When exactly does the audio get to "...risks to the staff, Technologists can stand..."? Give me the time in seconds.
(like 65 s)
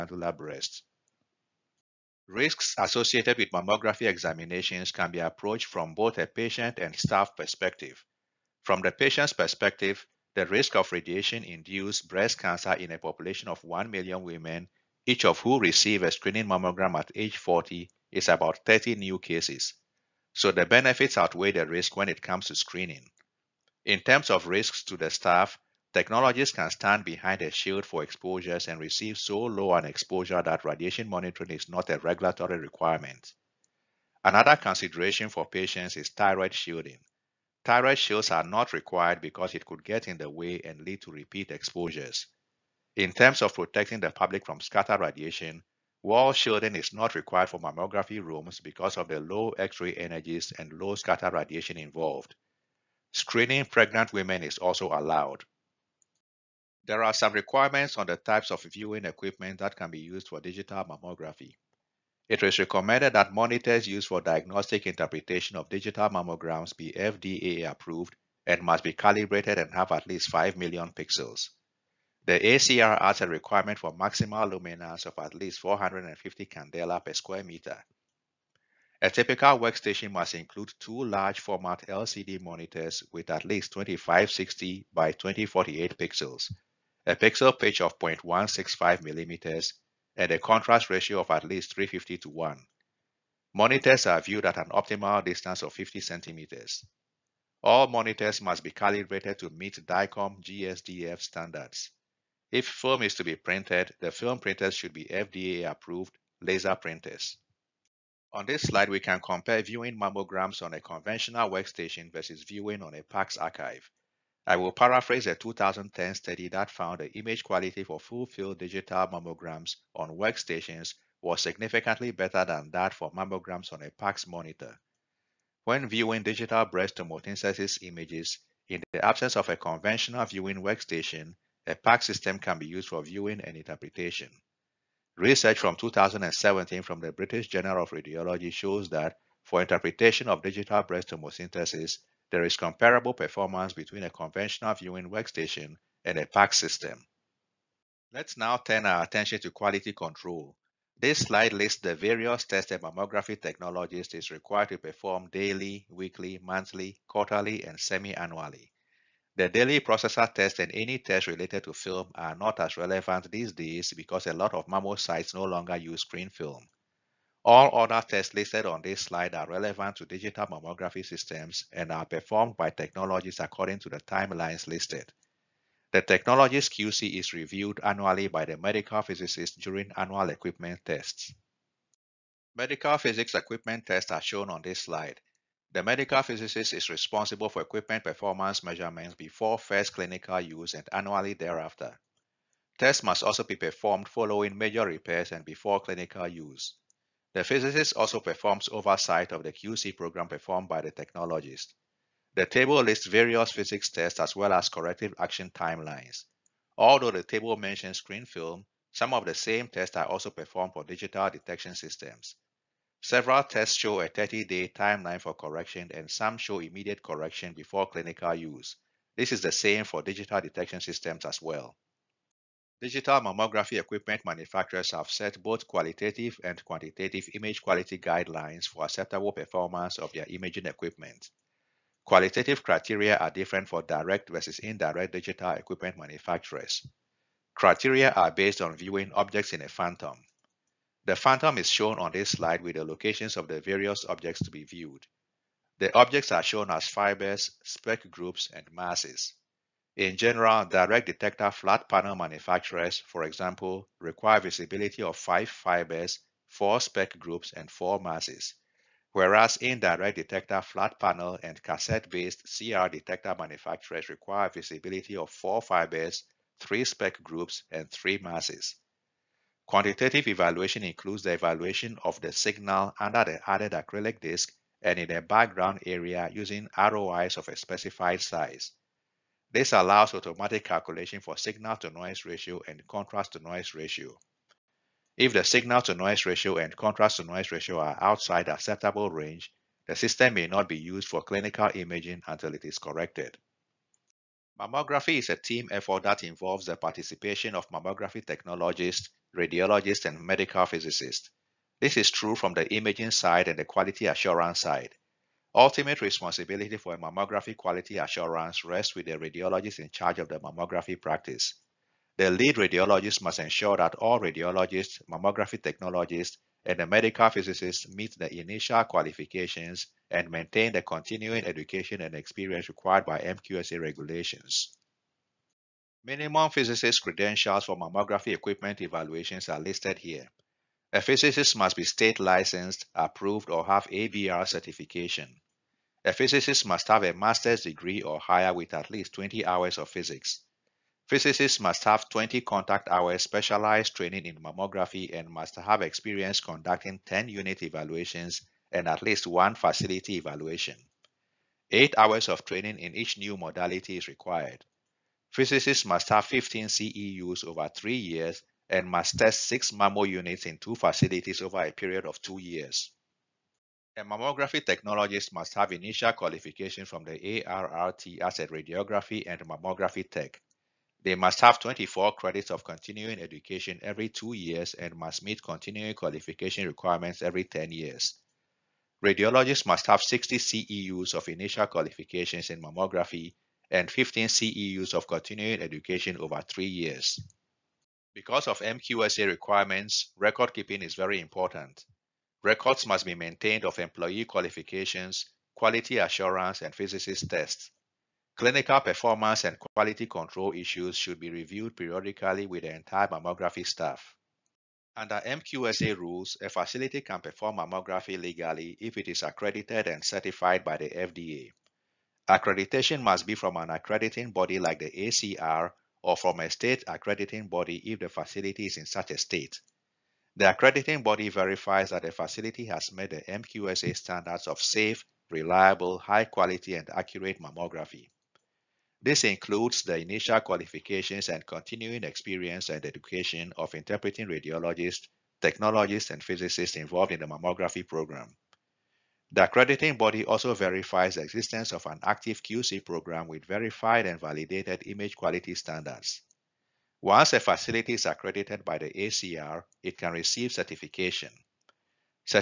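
24 s.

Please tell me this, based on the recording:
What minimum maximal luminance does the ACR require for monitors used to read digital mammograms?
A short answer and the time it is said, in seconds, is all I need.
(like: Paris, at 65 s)
450 candela per square meter, at 75 s.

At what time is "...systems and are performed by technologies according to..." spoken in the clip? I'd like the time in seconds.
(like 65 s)
171 s.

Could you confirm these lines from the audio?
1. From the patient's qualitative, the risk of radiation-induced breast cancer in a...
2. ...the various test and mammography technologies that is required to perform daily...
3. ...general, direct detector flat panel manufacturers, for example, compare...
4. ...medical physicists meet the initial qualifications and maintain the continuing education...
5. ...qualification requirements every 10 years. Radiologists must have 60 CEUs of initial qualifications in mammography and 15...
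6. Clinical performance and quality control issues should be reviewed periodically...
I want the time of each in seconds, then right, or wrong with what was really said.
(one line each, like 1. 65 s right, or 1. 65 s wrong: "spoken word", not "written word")
1. 8 s wrong: "perspective", not "qualitative"
2. 151 s right
3. 250 s wrong: "require", not "compare"
4. 316 s right
5. 375 s right
6. 398 s right.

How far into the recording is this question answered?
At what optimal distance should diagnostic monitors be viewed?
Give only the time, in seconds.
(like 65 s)
95 s.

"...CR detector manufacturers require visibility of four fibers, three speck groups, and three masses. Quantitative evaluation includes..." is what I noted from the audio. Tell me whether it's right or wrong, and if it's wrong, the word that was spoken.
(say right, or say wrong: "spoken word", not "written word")
right.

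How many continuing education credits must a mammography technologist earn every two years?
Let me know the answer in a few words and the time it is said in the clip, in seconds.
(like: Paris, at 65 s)
24, at 371 s.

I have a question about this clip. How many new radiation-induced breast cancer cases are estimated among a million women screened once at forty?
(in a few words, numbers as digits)
30.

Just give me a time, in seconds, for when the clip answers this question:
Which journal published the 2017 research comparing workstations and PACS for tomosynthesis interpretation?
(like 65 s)
137 s.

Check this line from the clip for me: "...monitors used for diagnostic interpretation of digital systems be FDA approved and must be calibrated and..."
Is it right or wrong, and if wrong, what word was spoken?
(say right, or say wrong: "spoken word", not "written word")
wrong: "mammograms", not "systems".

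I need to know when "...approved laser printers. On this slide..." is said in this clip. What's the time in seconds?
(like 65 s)
105 s.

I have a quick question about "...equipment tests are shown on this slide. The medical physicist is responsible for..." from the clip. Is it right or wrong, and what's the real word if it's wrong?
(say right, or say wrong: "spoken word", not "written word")
right.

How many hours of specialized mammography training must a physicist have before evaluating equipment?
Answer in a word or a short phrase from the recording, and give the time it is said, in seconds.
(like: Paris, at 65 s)
20 contact hours, at 342 s.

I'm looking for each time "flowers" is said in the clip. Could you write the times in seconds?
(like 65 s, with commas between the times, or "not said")
not said.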